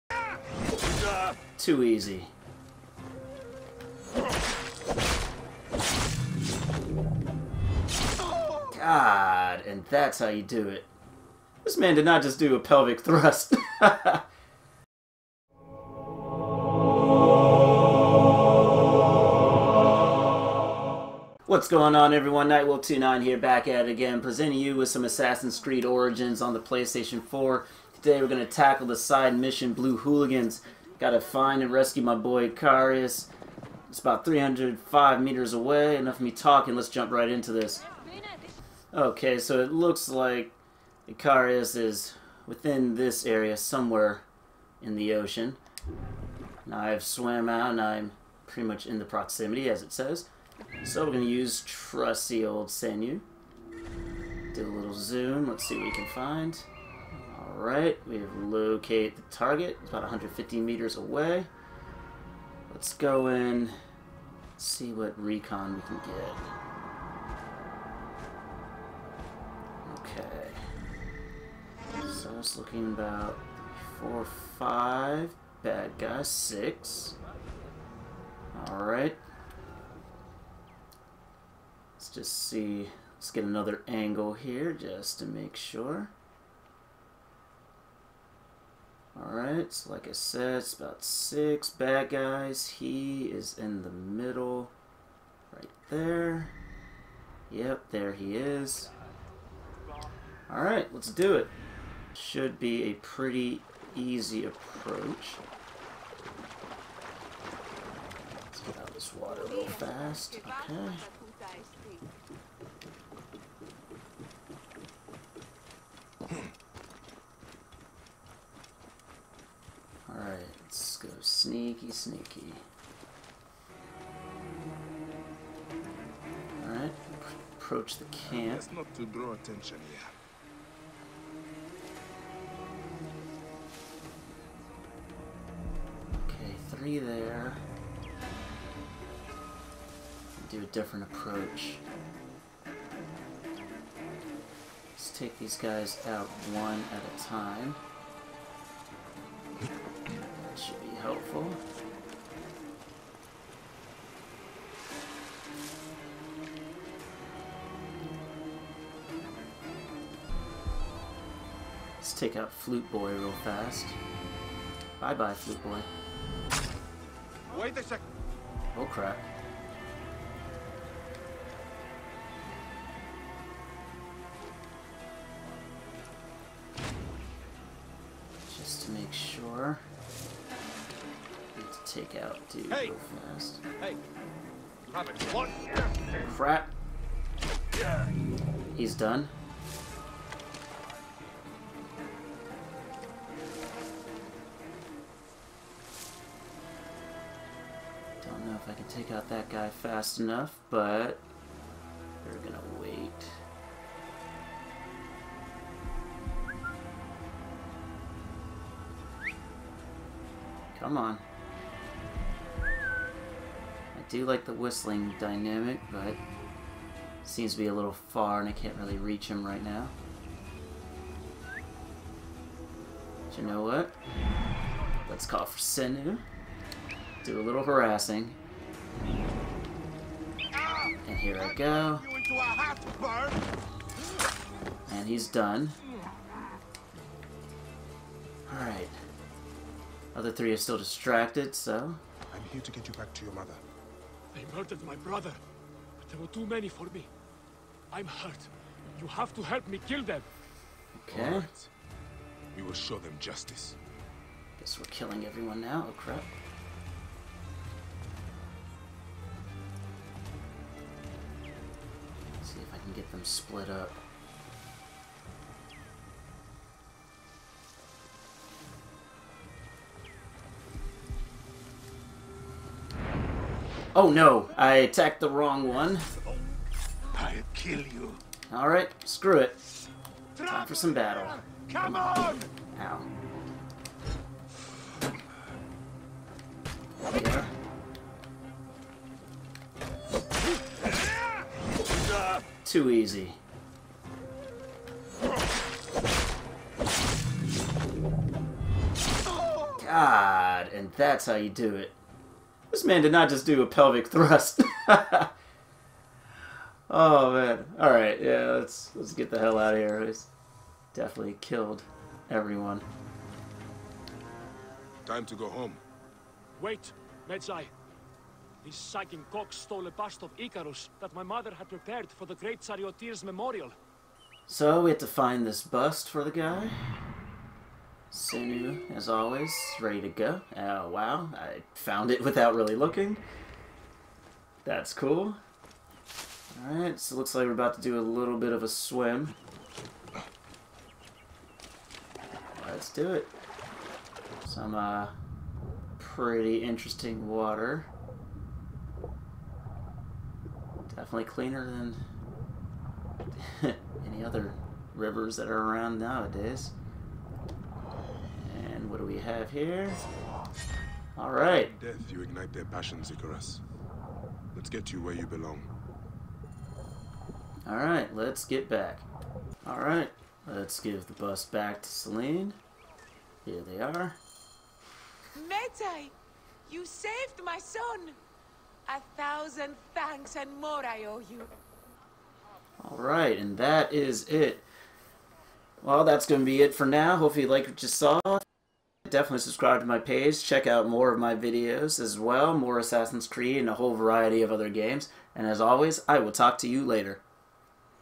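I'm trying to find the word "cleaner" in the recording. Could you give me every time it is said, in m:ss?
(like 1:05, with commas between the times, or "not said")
5:51.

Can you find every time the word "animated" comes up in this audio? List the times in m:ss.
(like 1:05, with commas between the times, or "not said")
not said.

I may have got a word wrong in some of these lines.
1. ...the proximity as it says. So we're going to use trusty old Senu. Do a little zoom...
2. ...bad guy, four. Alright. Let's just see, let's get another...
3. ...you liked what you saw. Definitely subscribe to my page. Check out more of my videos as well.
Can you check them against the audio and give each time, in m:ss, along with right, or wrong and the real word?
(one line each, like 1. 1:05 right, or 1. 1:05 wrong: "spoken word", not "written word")
1. 0:48 right
2. 1:15 wrong: "six", not "four"
3. 6:27 right.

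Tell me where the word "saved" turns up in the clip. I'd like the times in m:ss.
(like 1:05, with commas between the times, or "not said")
6:16.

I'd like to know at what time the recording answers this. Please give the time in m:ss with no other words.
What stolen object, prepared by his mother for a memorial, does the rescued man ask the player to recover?
5:19.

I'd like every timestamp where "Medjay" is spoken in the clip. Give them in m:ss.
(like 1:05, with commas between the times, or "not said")
5:17, 6:15.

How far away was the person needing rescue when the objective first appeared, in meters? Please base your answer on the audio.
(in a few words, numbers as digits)
305 meters.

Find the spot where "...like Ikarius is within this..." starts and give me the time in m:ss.
0:40.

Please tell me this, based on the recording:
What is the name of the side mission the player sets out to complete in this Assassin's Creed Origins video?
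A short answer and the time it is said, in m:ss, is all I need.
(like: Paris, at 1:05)
Blue Hooligans, at 0:29.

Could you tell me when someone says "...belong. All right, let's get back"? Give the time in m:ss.
6:05.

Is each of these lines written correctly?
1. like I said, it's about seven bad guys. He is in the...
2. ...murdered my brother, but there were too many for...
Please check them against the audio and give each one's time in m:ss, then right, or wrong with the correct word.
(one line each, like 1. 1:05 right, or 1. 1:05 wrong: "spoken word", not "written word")
1. 1:29 wrong: "six", not "seven"
2. 4:04 right.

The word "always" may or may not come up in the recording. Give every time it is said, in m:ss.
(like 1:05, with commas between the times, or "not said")
5:29, 6:35.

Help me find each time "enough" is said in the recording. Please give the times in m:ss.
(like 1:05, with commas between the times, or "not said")
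0:35, 3:20.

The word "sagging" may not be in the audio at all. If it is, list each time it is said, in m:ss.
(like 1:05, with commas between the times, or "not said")
5:18.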